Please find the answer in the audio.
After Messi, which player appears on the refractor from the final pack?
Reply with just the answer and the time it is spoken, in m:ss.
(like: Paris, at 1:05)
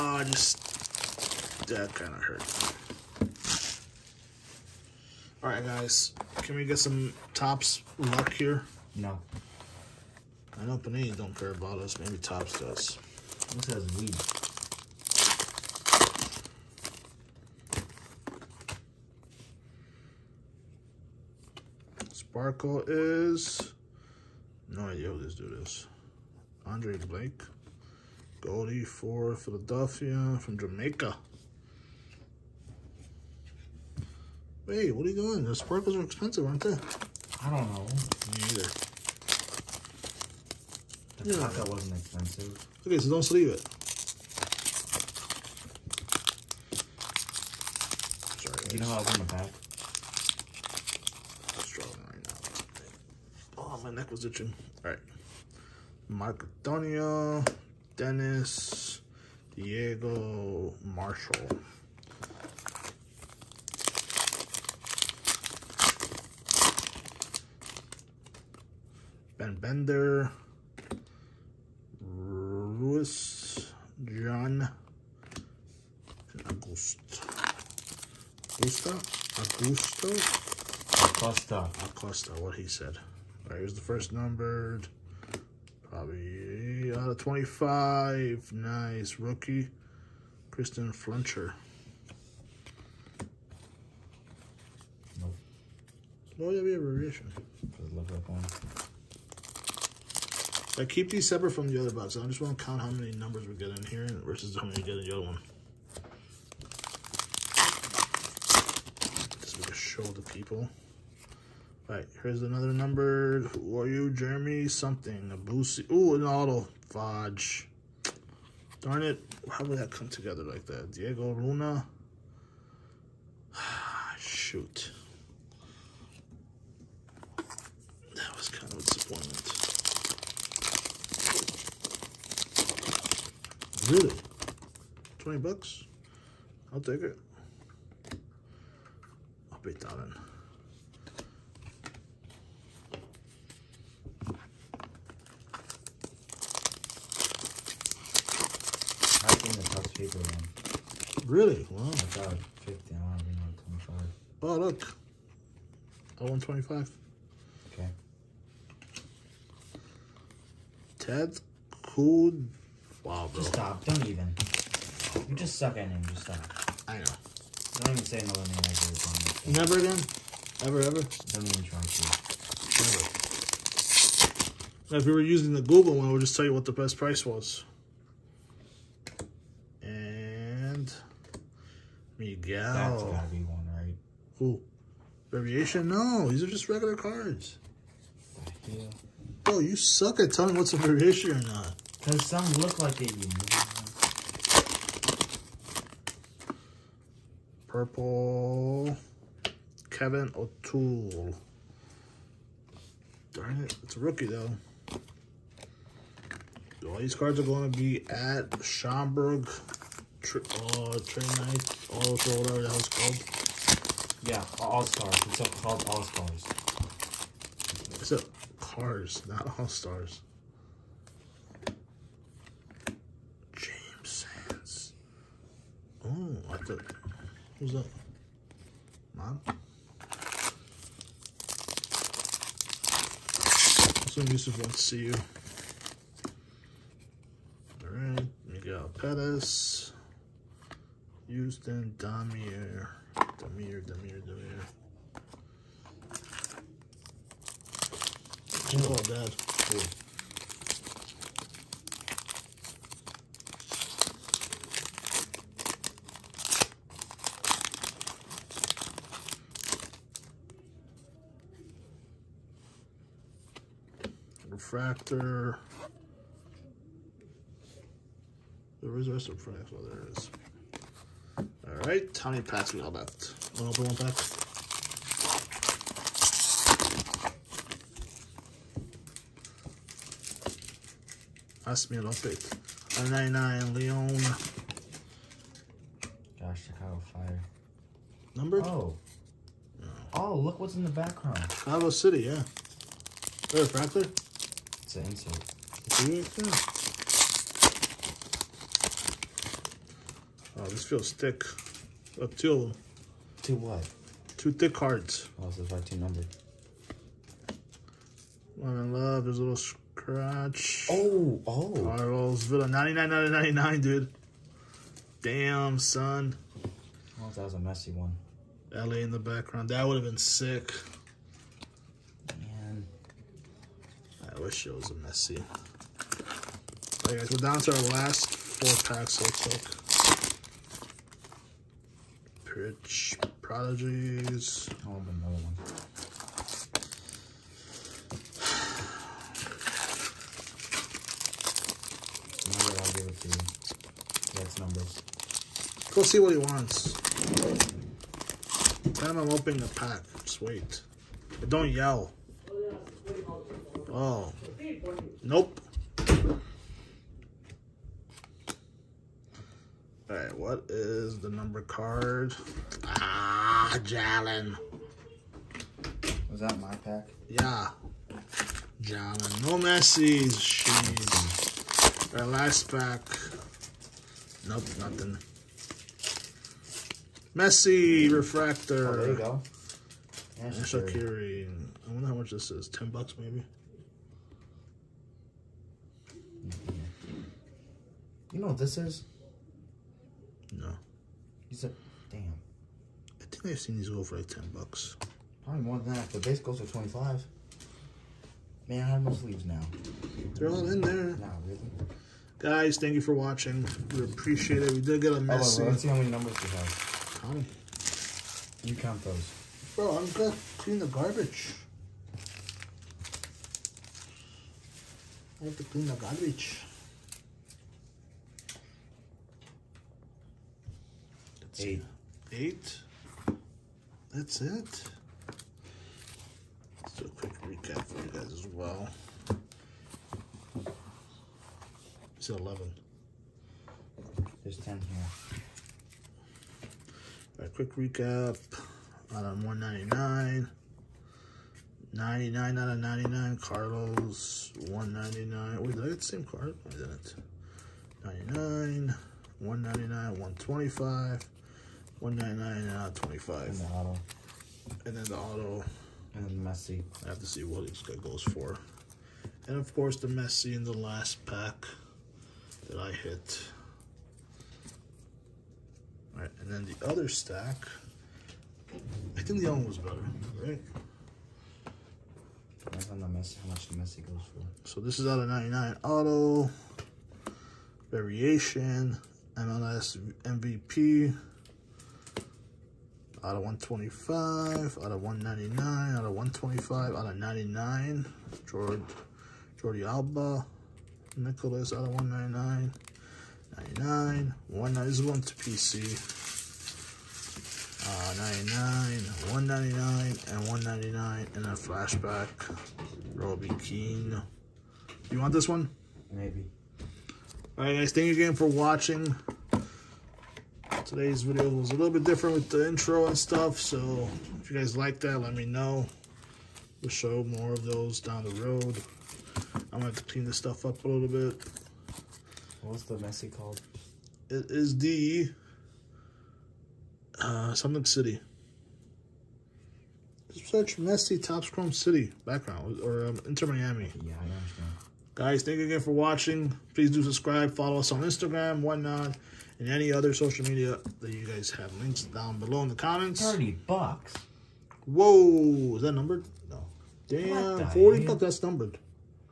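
Shaqiri, at 6:20.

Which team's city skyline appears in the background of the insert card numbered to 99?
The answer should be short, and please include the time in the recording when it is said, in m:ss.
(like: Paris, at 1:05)
Chicago Fire, at 4:46.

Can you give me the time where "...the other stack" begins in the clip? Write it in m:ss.
7:46.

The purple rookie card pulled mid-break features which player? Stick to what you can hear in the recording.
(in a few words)
Kevin O'Toole.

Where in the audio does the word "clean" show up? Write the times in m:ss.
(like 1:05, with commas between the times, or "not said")
6:50, 6:55, 8:40.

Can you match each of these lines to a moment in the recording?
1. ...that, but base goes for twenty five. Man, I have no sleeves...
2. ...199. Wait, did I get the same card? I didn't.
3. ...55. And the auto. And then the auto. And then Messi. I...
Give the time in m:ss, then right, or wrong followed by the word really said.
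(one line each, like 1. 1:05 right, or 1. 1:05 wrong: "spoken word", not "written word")
1. 6:35 right
2. 7:24 right
3. 7:32 wrong: "25", not "55".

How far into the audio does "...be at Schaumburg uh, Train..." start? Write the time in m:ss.
3:27.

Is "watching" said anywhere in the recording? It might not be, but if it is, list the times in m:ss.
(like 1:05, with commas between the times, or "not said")
6:43, 8:28, 8:55.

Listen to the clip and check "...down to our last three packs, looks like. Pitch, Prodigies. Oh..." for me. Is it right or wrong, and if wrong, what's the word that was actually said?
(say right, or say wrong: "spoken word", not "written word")
wrong: "four", not "three".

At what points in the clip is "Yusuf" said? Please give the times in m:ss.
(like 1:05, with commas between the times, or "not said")
3:54.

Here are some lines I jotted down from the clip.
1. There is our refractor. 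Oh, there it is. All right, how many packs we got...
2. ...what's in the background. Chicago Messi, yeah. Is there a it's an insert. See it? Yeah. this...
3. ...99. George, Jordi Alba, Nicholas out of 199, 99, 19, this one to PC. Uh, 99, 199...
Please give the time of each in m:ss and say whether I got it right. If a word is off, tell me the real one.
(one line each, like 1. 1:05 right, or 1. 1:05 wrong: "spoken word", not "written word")
1. 4:28 right
2. 4:50 wrong: "City", not "Messi"
3. 8:07 right.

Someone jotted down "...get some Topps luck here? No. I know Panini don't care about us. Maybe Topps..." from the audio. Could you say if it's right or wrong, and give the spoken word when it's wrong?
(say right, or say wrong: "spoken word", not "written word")
right.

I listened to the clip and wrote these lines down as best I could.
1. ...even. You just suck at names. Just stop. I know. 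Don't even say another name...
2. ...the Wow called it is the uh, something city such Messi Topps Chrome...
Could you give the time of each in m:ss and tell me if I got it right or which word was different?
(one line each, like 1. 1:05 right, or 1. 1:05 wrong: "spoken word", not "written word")
1. 2:44 right
2. 8:42 wrong: "Messi", not "Wow".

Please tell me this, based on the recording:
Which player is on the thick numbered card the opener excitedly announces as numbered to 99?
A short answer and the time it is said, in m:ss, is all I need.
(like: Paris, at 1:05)
Carlos Vela, at 5:11.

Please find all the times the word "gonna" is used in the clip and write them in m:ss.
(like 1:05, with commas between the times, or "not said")
6:50, 8:39.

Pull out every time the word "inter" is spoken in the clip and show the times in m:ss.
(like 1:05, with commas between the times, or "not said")
8:53.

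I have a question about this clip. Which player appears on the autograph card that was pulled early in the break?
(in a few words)
Diego Luna.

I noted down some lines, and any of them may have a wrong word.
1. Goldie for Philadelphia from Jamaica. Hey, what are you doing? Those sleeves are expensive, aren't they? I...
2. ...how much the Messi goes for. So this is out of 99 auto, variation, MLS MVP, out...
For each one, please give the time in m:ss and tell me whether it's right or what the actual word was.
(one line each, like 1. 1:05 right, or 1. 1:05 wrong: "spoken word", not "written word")
1. 0:28 wrong: "sparkles", not "sleeves"
2. 7:53 right.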